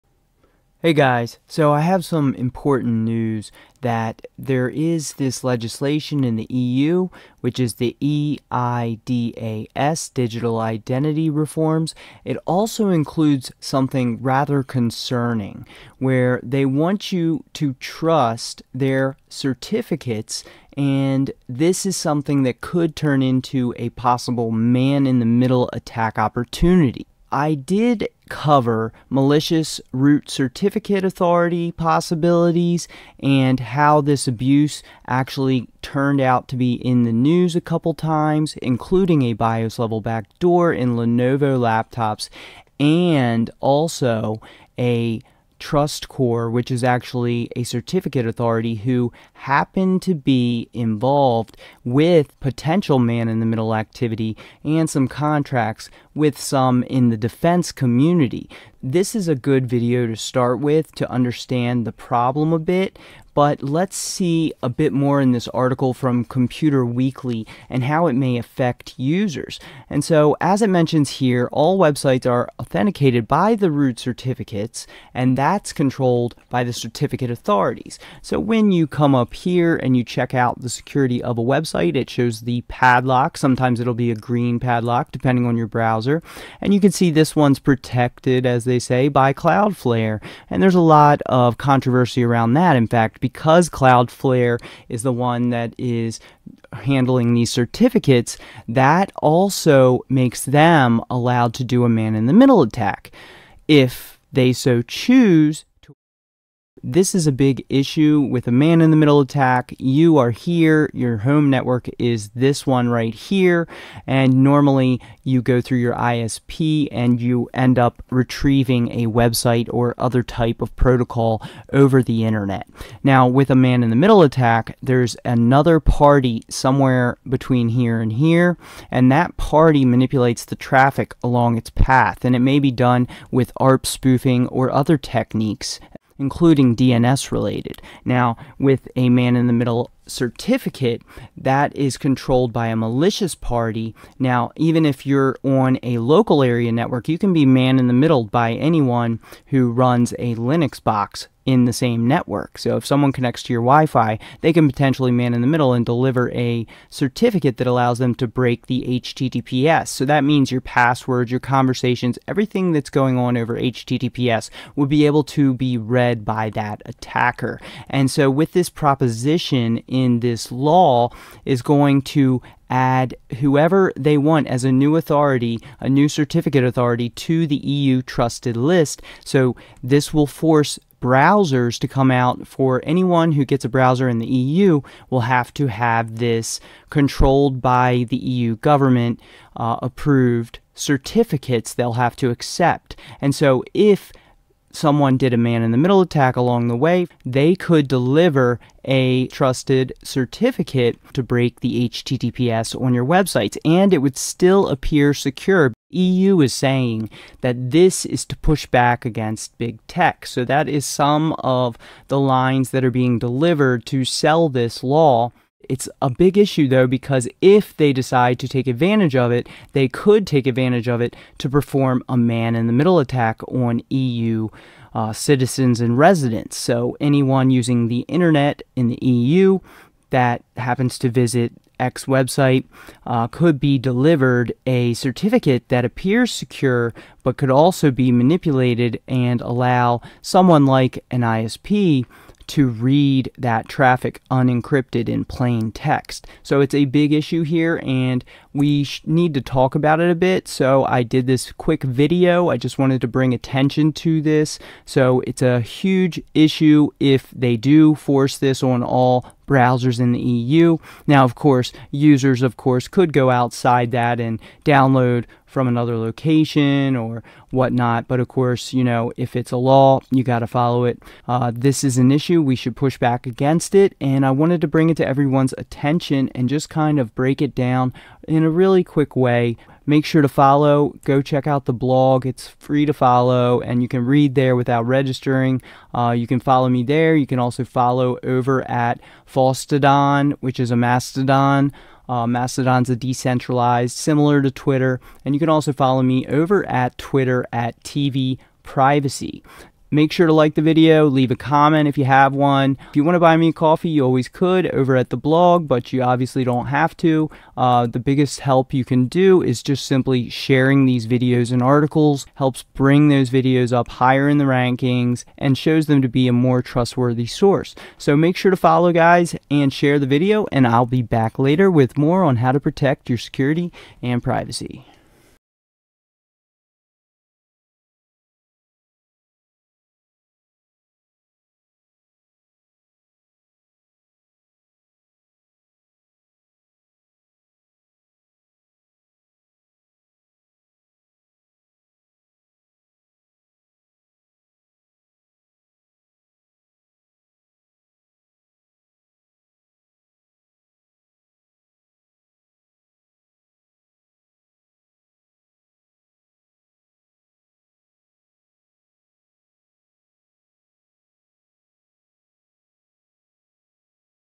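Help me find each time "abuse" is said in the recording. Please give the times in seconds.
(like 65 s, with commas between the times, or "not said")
34 s.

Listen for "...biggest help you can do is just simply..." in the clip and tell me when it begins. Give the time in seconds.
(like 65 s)
307 s.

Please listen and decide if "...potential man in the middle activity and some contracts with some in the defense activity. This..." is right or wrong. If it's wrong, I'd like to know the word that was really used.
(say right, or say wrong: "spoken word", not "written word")
wrong: "community", not "activity".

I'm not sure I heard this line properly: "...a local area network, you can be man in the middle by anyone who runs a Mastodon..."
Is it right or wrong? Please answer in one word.
wrong.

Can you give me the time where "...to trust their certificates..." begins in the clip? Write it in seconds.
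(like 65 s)
17 s.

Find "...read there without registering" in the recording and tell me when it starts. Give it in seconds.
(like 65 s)
284 s.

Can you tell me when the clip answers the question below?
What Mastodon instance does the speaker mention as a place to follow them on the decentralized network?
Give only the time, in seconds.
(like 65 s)
289 s.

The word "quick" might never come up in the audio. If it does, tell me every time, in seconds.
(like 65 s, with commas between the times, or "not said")
251 s, 278 s.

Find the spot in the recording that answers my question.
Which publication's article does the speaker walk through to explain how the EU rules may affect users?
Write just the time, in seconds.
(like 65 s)
66 s.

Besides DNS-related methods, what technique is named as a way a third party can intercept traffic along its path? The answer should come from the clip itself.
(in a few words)
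ARP spoofing.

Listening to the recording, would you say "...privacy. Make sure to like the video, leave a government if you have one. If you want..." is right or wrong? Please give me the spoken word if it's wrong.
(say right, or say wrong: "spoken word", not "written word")
wrong: "comment", not "government".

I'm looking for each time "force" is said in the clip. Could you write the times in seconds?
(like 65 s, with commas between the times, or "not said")
180 s, 257 s.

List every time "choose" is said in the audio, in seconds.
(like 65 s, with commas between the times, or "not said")
104 s.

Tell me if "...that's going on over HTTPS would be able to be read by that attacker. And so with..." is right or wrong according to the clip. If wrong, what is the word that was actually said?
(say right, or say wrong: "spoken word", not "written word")
right.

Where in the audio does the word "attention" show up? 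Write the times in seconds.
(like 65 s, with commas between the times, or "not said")
253 s, 275 s.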